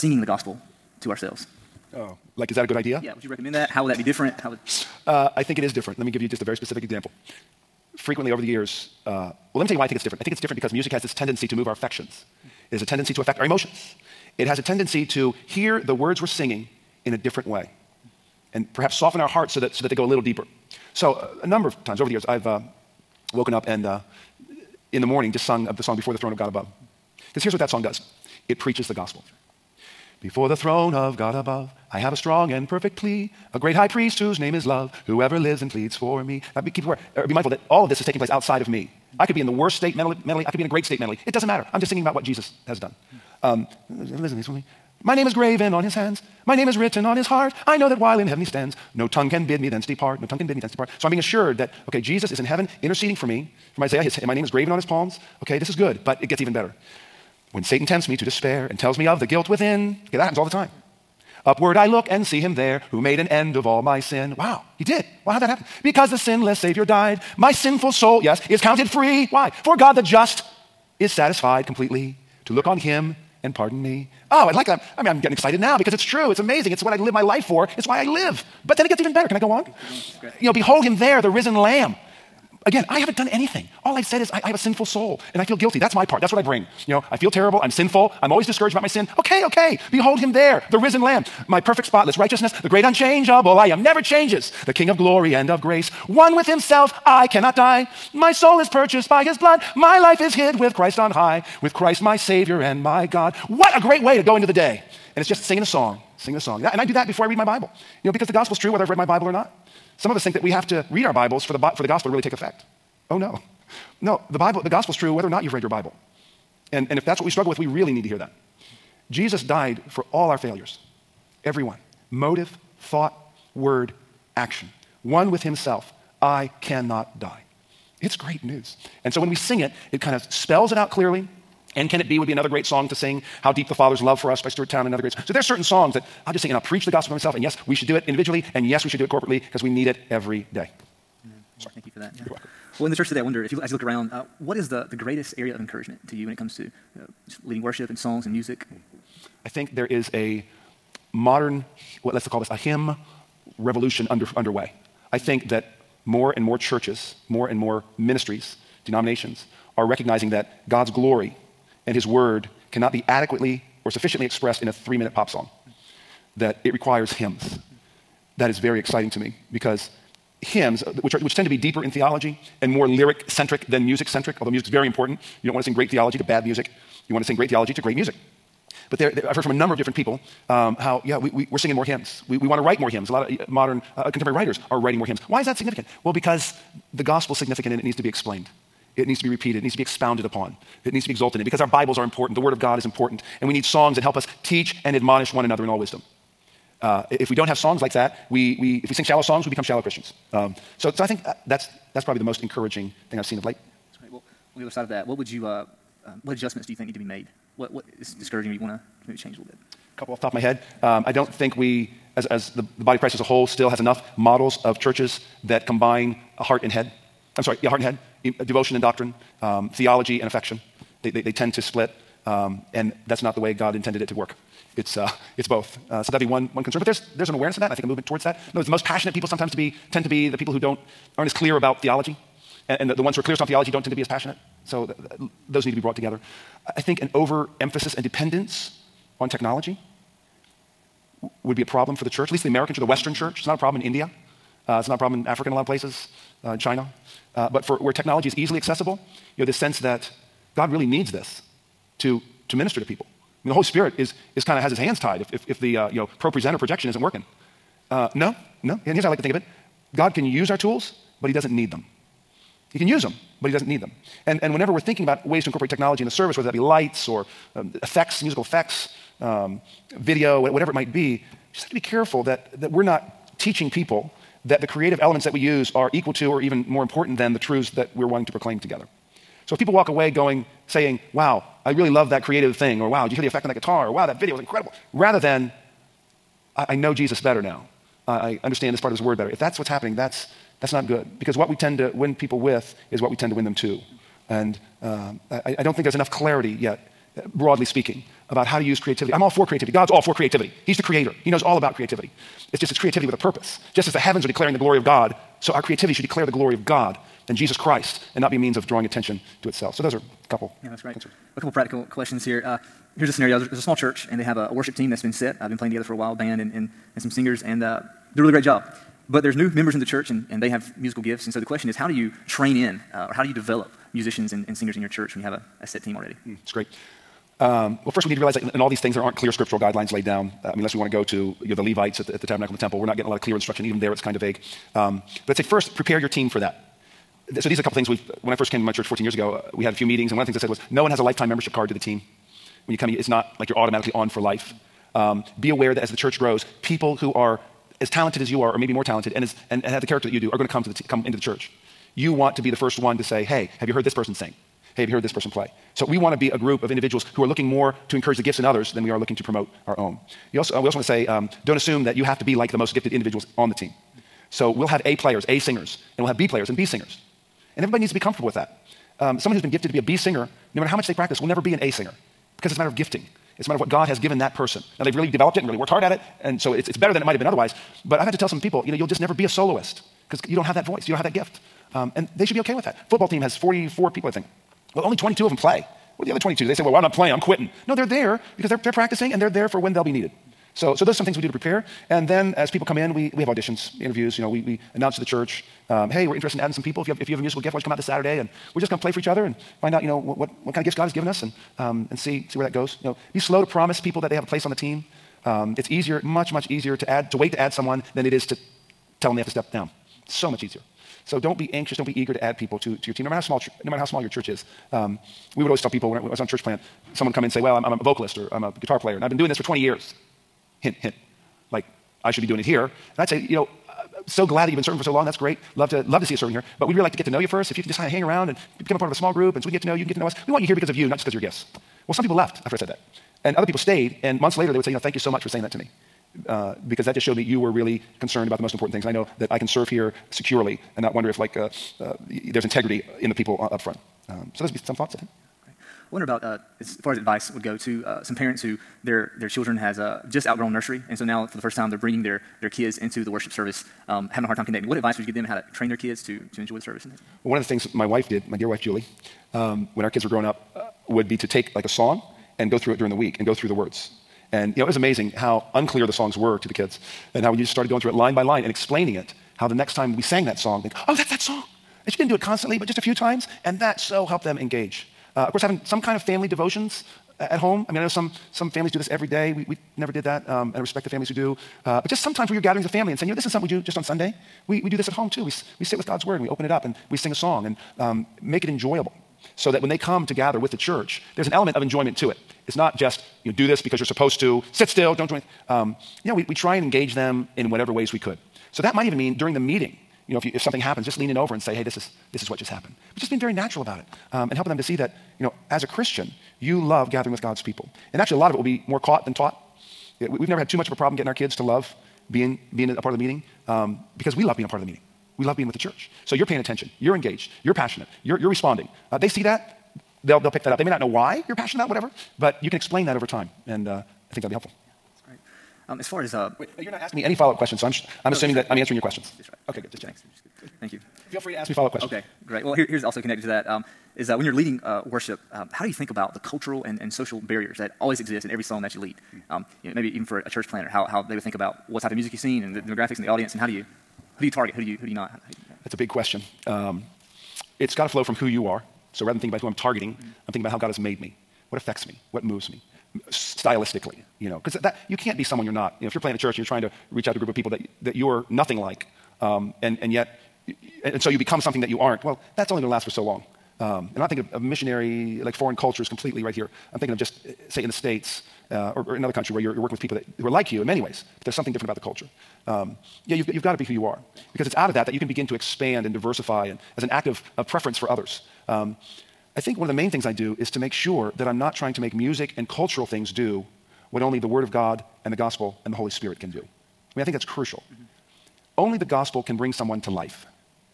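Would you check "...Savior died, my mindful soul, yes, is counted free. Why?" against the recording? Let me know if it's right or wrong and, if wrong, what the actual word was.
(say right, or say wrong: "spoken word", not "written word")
wrong: "sinful", not "mindful".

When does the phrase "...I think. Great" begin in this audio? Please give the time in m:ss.
7:24.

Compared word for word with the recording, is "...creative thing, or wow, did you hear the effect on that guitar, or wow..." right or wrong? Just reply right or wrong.
right.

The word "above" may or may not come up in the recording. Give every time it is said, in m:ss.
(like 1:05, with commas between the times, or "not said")
0:26, 0:31.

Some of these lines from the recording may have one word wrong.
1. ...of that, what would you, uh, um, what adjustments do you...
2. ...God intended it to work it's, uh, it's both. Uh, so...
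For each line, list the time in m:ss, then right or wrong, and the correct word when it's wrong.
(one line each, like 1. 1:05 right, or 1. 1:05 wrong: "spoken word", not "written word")
1. 3:24 right
2. 3:43 right.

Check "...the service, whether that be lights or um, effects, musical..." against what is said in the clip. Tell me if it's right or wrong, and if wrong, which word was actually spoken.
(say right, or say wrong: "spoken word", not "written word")
right.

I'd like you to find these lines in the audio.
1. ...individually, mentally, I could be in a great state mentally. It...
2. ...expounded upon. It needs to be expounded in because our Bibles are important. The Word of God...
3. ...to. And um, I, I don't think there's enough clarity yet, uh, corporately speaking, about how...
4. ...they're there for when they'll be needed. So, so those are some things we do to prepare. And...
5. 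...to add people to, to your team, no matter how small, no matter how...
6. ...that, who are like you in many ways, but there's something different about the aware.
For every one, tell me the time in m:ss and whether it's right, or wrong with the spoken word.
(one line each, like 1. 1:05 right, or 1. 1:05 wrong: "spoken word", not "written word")
1. 0:39 wrong: "mentally", not "individually"
2. 3:09 wrong: "exalted", not "expounded"
3. 4:53 wrong: "broadly", not "corporately"
4. 6:29 right
5. 6:52 right
6. 9:29 wrong: "culture", not "aware".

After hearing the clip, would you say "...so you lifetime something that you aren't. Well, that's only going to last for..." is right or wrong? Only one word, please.
wrong.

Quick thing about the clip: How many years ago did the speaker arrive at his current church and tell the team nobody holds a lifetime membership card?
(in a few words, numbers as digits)
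14.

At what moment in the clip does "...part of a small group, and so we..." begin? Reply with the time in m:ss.
7:08.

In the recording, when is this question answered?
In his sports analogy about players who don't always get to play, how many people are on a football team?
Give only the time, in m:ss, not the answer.
6:23.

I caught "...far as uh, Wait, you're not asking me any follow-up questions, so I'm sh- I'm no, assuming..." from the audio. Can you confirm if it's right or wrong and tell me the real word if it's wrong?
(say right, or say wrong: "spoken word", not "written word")
right.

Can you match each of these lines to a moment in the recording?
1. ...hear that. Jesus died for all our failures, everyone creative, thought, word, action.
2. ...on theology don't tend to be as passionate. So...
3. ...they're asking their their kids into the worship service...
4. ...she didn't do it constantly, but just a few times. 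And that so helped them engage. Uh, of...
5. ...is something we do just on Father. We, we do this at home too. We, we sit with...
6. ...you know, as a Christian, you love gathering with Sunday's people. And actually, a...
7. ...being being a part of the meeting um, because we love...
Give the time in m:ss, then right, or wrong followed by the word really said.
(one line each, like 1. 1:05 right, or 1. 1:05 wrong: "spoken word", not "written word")
1. 1:58 wrong: "motive", not "creative"
2. 3:53 right
3. 7:31 wrong: "bringing", not "asking"
4. 7:51 right
5. 8:03 wrong: "Sunday", not "Father"
6. 8:25 wrong: "God", not "Sunday"
7. 8:32 right.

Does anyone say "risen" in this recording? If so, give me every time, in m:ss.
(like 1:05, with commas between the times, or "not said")
1:21, 1:30.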